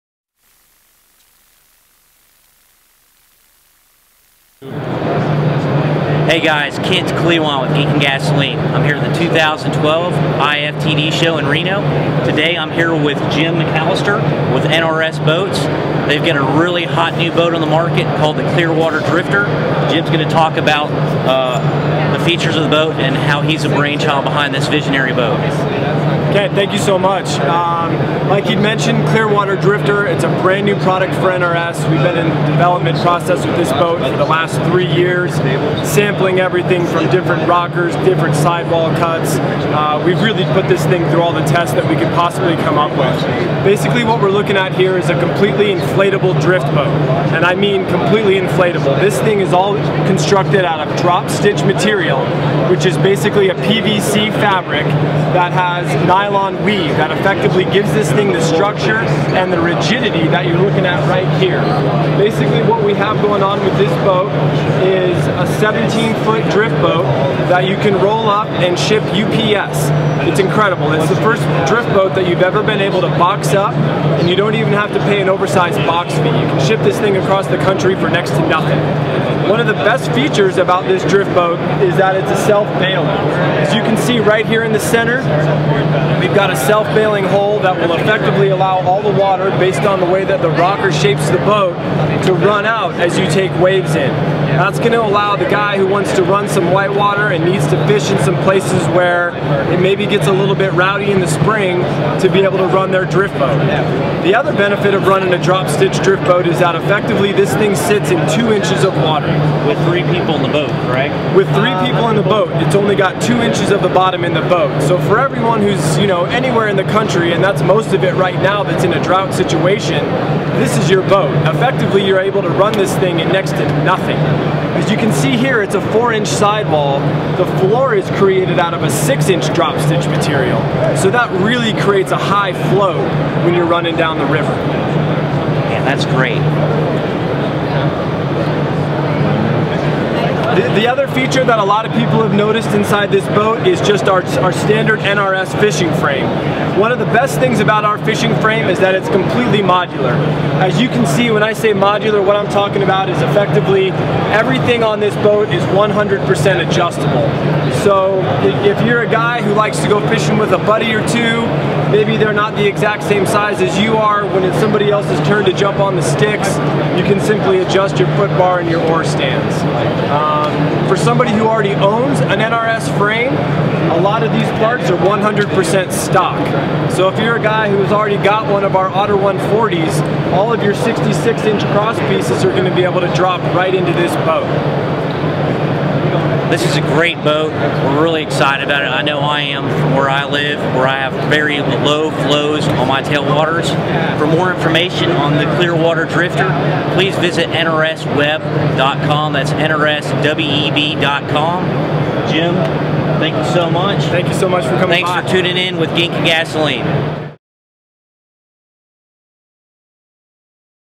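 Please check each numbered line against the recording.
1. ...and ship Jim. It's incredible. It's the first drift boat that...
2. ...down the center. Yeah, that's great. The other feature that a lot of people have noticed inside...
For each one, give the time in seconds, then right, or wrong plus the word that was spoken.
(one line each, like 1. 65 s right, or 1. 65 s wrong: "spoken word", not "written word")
1. 68 s wrong: "UPS", not "Jim"
2. 133 s wrong: "river", not "center".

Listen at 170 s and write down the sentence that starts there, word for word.
Um, for somebody who already owns an NRS frame, a lot of these parts are 100% stock.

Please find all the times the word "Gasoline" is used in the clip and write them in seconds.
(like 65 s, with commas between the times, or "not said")
7 s, 206 s.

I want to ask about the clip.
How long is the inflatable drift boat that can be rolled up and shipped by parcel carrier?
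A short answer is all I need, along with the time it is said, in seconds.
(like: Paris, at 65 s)
17 foot, at 65 s.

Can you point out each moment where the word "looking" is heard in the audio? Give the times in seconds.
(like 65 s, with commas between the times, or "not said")
44 s, 60 s.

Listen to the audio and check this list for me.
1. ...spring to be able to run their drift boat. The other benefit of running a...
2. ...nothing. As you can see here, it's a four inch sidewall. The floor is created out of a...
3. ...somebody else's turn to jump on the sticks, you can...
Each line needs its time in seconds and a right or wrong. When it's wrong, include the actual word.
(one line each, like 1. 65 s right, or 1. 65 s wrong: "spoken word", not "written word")
1. 101 s right
2. 123 s right
3. 164 s right.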